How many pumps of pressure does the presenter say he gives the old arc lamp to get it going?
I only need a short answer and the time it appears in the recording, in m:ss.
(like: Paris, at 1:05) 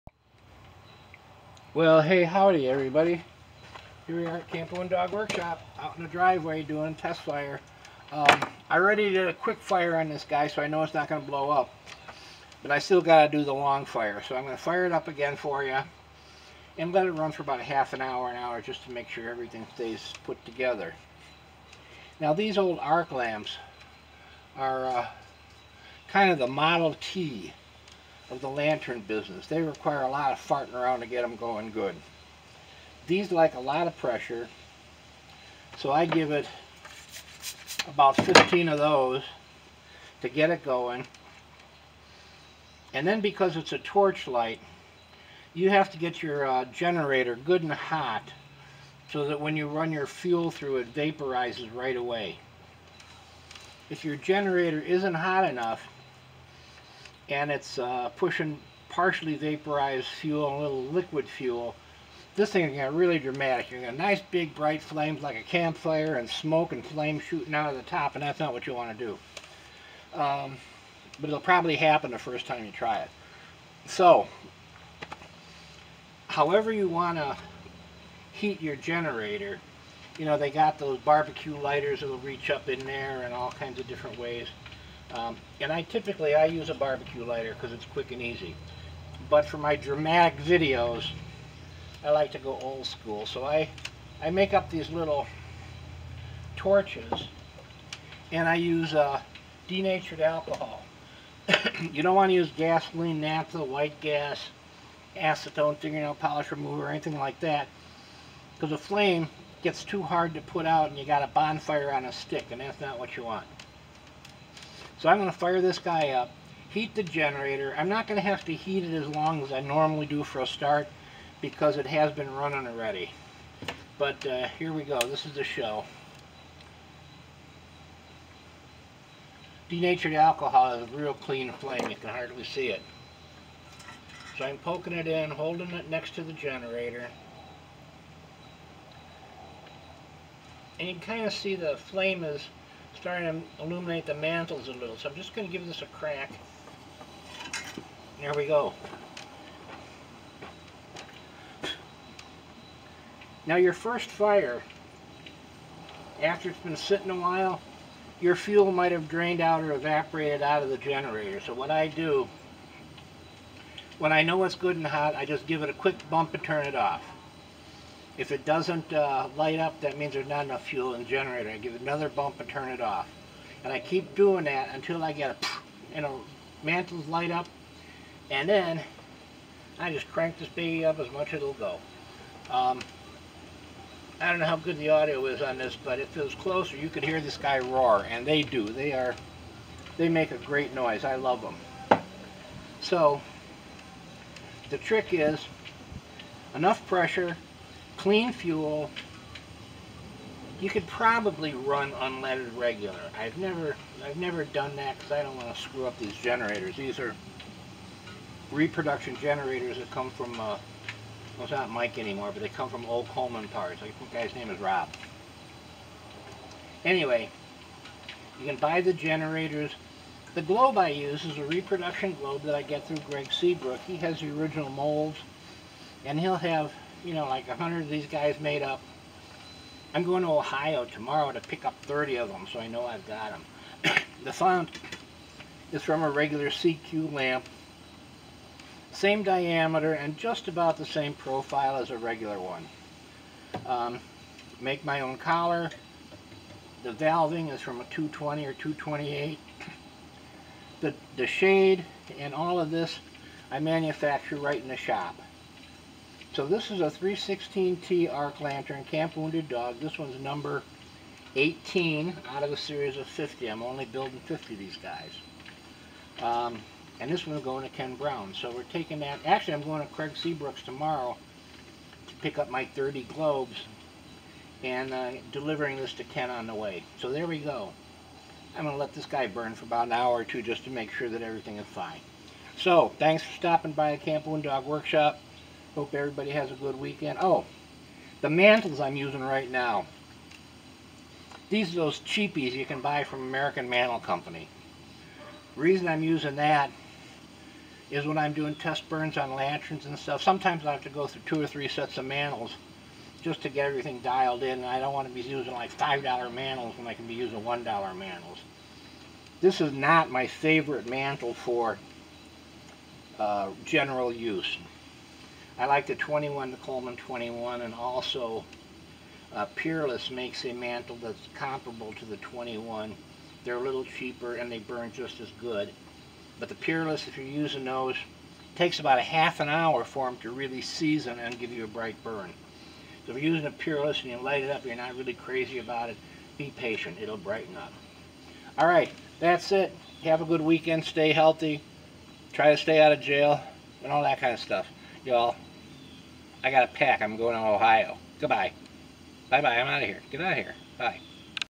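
15, at 0:38.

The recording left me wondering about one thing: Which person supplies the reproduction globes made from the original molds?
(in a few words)
Greg Seabrook.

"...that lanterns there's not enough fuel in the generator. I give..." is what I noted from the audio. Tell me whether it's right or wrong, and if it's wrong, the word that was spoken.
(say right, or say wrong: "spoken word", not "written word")
wrong: "means", not "lanterns".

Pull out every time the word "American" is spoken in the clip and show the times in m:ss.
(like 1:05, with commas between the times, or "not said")
4:53.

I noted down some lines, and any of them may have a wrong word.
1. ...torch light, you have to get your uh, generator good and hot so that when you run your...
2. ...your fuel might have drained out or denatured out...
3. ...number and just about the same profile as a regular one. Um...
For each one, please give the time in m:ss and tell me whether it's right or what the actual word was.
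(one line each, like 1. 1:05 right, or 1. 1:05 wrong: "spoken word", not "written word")
1. 0:43 right
2. 2:38 wrong: "evaporated", not "denatured"
3. 3:59 wrong: "diameter", not "number".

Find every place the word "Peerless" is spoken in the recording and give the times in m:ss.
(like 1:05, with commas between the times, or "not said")
5:19, 5:26, 5:33.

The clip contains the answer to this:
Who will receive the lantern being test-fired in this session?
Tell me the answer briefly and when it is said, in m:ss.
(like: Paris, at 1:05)
Ken Brown, at 4:27.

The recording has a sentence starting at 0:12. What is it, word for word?
But I still got to do the long fire, so I'm going to fire it up again for you.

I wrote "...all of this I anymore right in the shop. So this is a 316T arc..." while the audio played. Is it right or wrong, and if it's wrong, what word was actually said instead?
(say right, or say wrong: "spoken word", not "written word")
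wrong: "manufacture", not "anymore".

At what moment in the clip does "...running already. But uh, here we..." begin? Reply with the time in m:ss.
2:02.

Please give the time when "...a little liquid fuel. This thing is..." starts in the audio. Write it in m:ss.
1:00.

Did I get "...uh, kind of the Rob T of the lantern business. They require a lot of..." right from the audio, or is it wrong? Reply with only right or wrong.
wrong.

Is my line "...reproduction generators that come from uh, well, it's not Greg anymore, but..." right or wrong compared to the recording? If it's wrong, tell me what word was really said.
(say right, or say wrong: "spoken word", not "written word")
wrong: "Mike", not "Greg".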